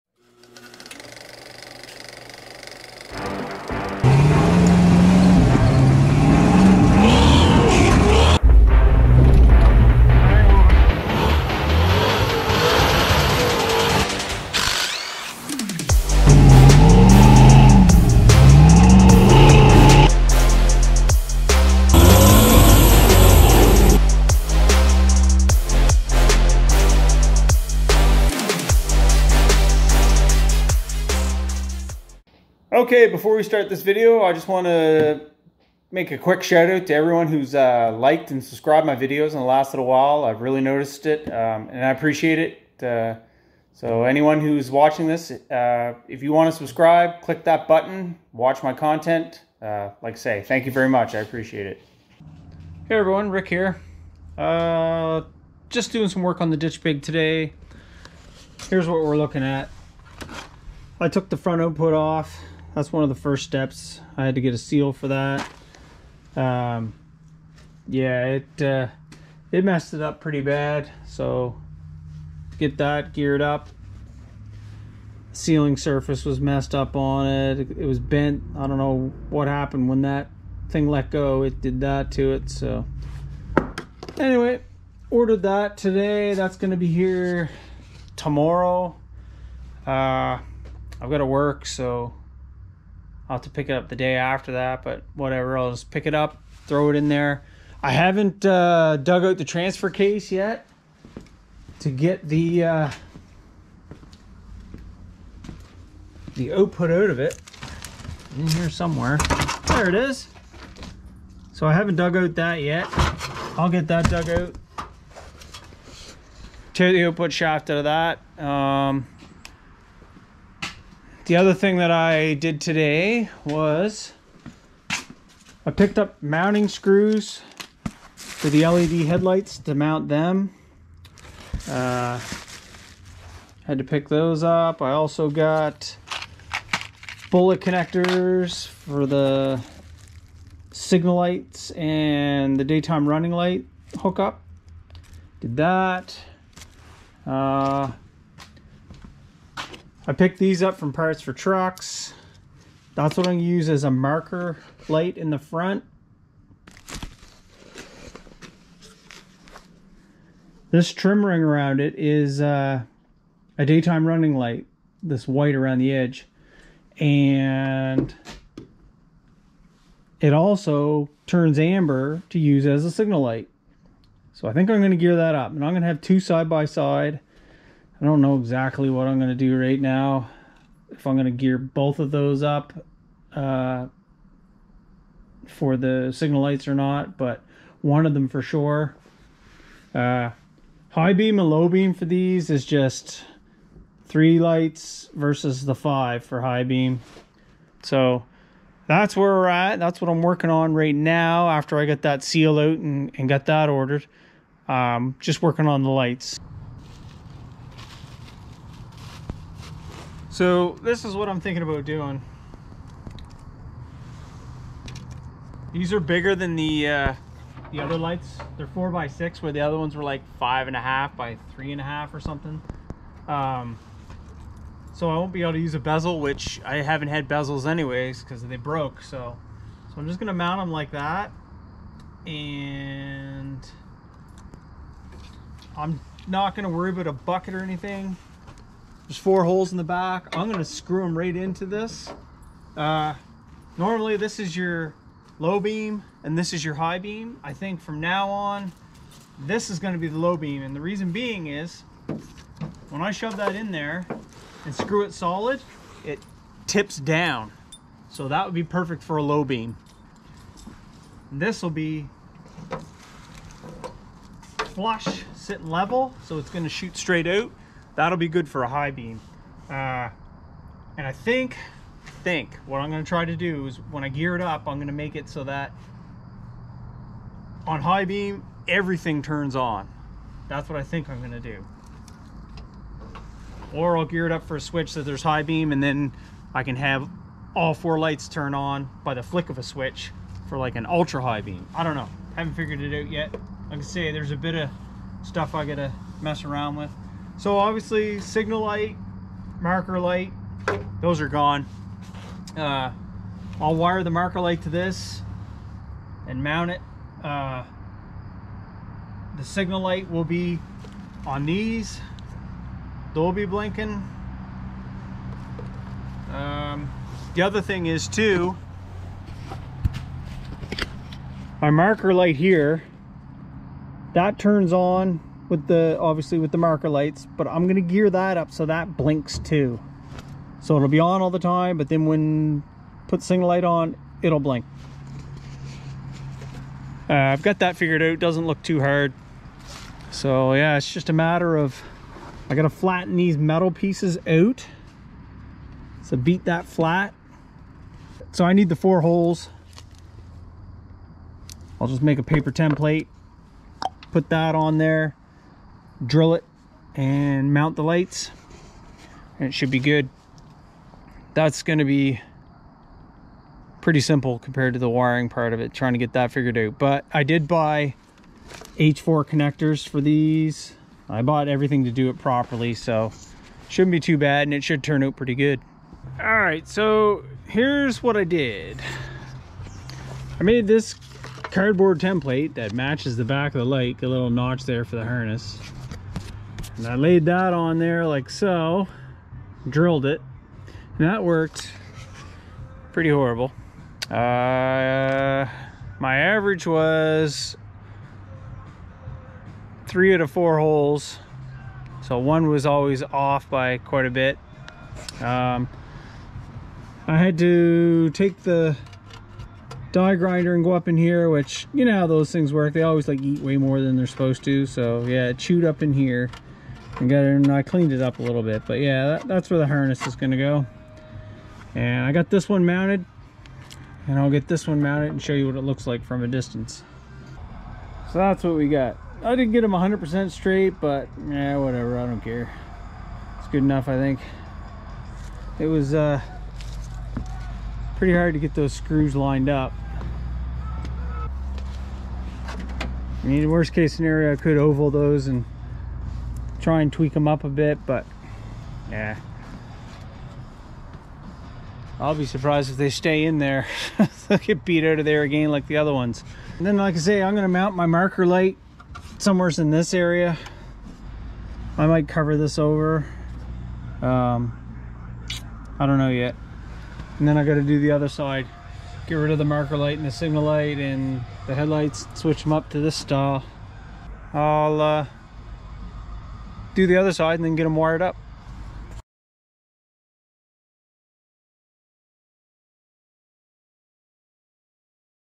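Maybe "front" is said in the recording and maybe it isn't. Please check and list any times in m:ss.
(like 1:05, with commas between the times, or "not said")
1:01, 2:35.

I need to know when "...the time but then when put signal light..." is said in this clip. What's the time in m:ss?
5:31.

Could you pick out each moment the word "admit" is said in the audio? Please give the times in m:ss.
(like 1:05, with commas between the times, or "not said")
not said.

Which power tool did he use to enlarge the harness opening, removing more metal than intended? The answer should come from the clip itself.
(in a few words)
die grinder.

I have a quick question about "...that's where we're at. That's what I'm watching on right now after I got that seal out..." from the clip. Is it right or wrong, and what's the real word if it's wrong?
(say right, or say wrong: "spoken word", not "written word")
wrong: "working", not "watching".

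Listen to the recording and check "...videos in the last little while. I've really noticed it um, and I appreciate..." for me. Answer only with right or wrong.
right.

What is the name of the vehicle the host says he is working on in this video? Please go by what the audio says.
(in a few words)
ditch pig.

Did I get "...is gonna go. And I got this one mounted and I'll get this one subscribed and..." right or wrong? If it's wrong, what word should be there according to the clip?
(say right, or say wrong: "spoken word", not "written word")
wrong: "mounted", not "subscribed".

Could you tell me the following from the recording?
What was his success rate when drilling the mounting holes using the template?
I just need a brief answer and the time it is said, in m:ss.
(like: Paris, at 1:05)
3 out of 4, at 6:39.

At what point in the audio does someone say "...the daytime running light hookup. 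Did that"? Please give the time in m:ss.
2:22.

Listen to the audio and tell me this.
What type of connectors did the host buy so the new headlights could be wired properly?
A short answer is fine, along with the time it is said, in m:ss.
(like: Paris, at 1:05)
H4 connectors, at 6:08.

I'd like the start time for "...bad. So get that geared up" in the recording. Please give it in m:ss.
1:10.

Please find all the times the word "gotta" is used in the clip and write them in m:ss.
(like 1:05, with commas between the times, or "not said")
4:55, 5:42, 7:47.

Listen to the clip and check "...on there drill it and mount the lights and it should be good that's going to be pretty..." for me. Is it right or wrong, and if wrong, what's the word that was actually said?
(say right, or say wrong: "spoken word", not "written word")
right.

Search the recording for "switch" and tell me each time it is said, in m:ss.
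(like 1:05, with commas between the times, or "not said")
4:44, 4:49, 7:52.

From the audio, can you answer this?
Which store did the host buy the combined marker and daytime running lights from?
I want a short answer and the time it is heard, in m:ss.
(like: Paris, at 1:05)
Parts for Trucks, at 2:30.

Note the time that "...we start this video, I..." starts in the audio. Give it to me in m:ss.
0:33.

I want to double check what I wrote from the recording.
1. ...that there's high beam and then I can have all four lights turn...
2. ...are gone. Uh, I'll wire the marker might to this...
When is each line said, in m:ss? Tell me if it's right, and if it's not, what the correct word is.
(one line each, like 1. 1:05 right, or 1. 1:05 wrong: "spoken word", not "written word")
1. 4:44 right
2. 5:01 wrong: "light", not "might".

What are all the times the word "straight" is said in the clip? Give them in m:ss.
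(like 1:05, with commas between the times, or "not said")
4:26, 7:10.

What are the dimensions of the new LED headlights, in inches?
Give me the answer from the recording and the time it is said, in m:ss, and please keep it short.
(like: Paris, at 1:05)
4 by 6, at 3:38.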